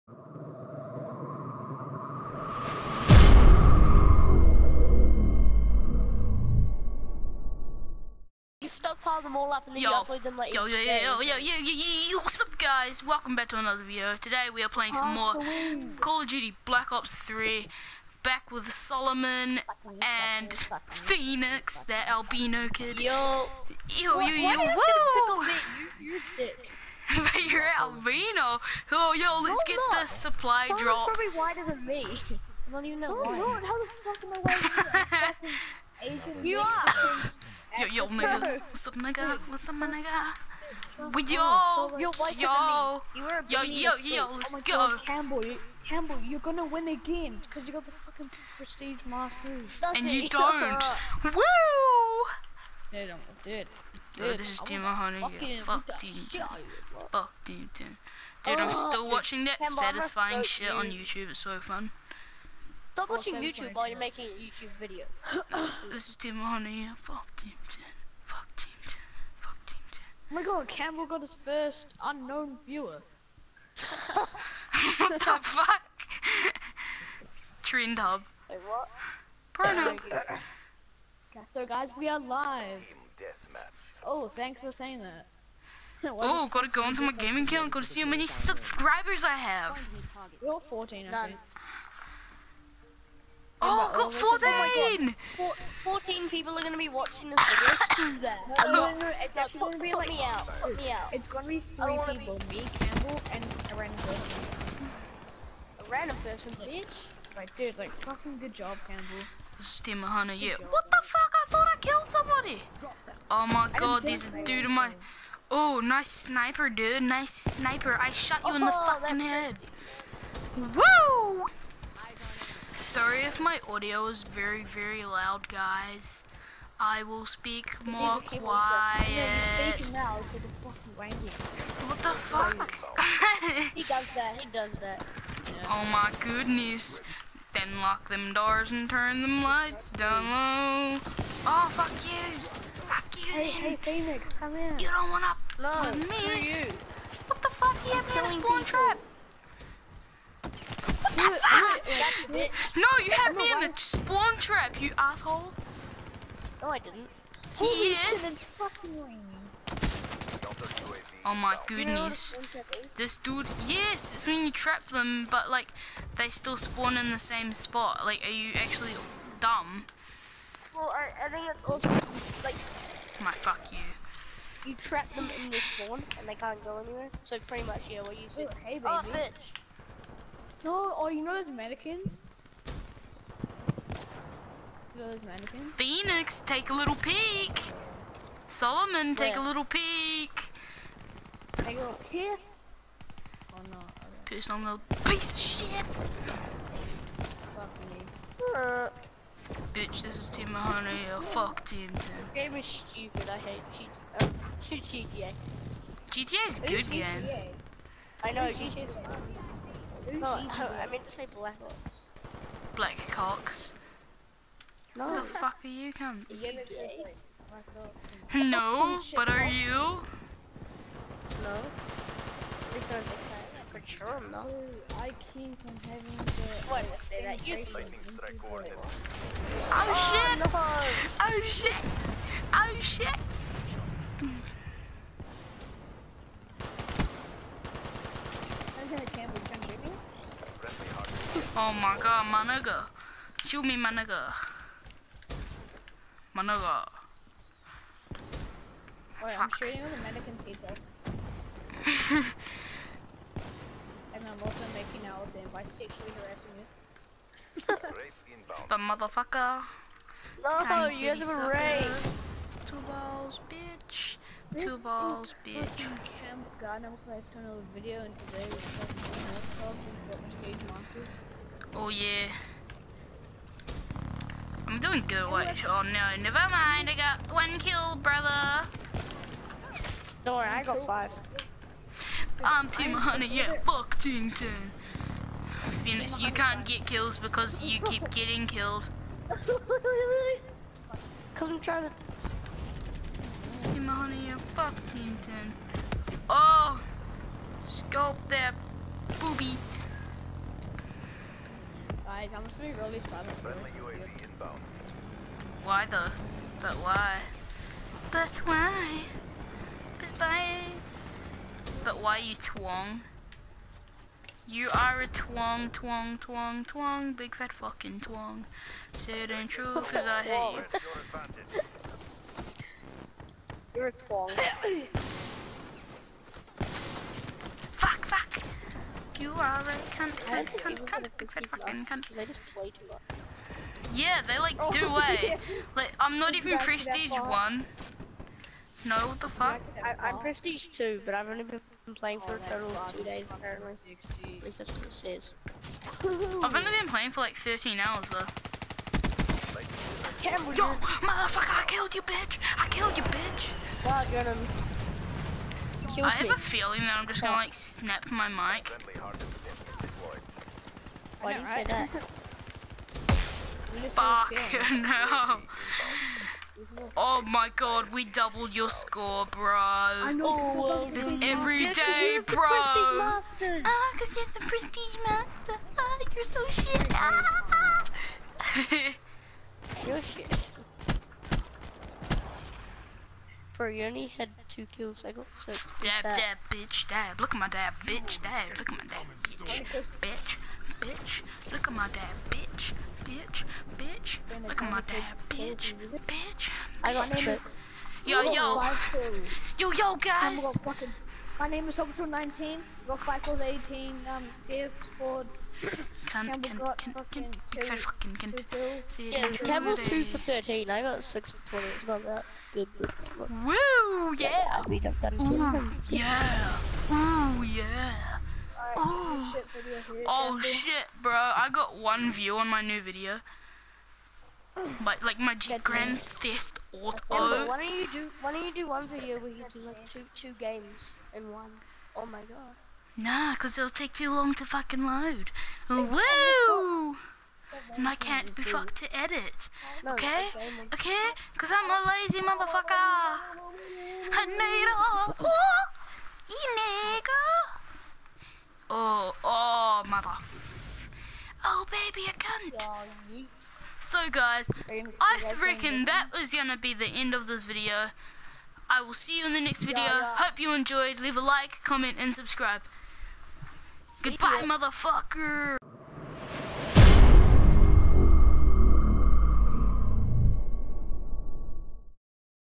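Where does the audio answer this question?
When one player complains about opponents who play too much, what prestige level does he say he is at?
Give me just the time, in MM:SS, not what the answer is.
05:40.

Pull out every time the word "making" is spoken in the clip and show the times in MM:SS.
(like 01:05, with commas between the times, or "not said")
01:03, 04:14.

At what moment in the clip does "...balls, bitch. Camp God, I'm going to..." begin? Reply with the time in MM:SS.
04:24.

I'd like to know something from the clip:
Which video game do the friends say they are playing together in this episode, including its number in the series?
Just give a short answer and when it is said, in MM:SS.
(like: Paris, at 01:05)
Call of Duty Black Ops 3, at 00:15.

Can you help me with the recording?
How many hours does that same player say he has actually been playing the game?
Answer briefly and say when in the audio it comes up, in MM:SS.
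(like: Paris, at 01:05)
13 hours, at 05:47.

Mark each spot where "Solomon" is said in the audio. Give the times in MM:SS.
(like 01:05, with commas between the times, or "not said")
00:18, 00:30, 03:08.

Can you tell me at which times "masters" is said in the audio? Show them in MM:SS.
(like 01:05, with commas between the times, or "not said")
00:49, 06:15.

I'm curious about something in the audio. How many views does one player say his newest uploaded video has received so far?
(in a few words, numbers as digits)
1 view.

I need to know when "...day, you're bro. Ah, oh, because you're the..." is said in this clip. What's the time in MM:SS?
06:11.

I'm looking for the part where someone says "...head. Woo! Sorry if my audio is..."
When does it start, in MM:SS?
01:59.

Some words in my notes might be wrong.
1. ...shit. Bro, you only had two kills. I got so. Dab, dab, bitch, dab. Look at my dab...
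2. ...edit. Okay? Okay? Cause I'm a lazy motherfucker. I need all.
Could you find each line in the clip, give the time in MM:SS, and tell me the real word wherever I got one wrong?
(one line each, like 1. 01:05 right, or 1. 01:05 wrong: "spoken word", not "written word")
1. 06:20 right
2. 07:18 right.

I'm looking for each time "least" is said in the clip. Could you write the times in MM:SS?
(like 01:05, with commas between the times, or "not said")
03:42, 05:44.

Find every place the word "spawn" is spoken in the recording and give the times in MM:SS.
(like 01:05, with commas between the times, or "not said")
02:28, 02:33, 02:46, 02:55.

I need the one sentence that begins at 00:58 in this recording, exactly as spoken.
Dude, I'm oh, still watching that satisfying shit on YouTube.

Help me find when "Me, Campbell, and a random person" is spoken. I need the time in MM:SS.
01:42.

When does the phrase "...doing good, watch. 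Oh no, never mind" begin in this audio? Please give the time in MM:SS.
04:34.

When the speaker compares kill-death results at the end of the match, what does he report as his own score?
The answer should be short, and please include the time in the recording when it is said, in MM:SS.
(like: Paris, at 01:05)
6 for 20, at 06:51.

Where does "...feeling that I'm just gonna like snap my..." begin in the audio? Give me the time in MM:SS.
05:56.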